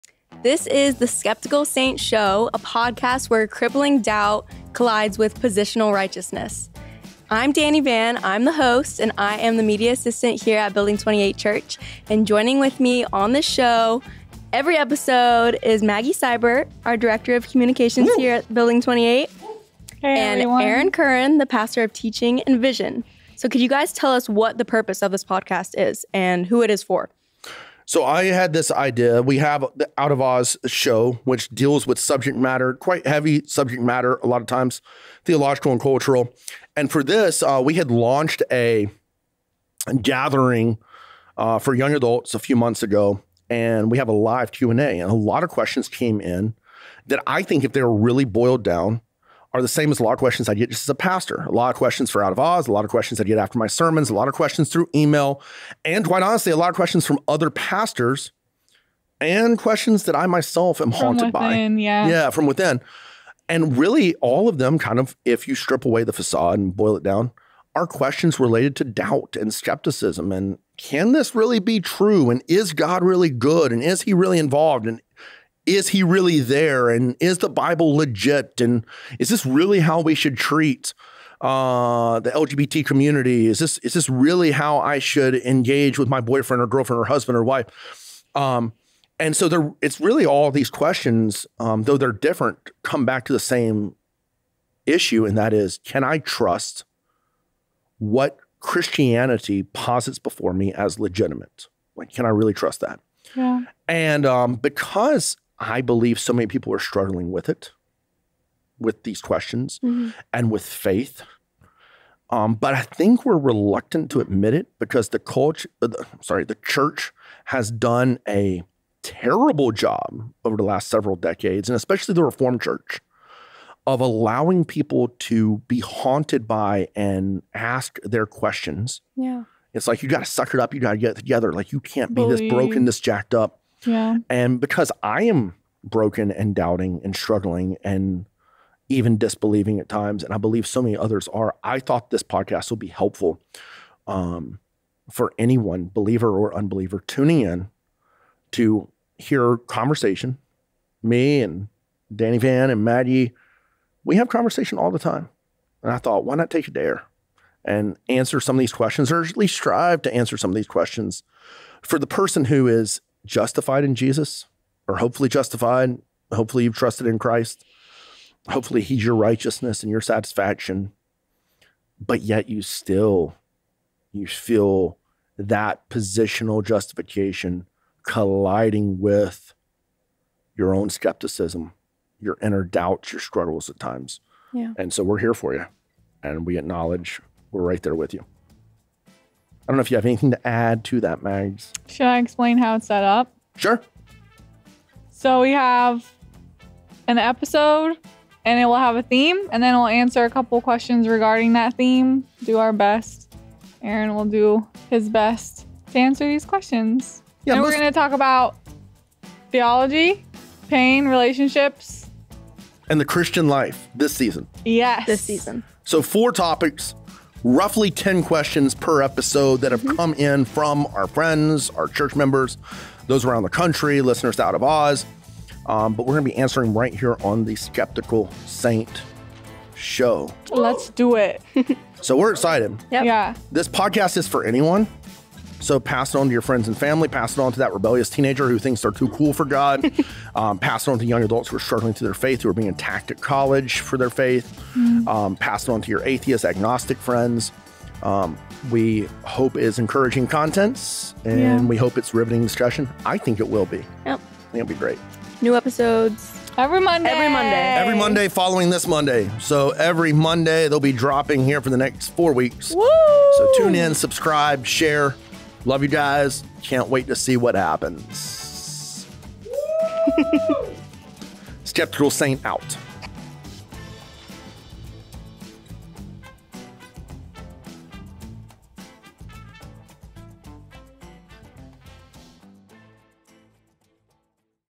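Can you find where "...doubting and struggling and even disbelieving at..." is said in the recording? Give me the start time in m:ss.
2:16.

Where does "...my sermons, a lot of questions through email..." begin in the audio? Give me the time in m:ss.
0:53.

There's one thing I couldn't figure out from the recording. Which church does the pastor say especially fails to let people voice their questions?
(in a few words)
Reformed Church.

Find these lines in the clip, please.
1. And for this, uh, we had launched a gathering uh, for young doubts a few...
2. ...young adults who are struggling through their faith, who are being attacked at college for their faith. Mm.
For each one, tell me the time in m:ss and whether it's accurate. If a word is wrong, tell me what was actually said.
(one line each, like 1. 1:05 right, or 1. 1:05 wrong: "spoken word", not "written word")
1. 0:36 wrong: "adults", not "doubts"
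2. 4:01 right.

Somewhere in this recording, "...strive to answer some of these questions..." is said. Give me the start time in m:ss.
2:39.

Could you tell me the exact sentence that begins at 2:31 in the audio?
Me and Dani Van and Maddie, we have conversation all the time.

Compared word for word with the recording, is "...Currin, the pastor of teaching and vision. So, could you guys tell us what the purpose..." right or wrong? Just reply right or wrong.
right.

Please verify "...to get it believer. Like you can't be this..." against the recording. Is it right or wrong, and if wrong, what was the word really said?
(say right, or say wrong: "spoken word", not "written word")
wrong: "together", not "believer".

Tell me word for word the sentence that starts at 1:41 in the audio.
Like, can I really trust that?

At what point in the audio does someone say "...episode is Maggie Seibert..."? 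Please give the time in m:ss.
0:14.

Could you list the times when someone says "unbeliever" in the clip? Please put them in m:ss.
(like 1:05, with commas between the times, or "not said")
2:26.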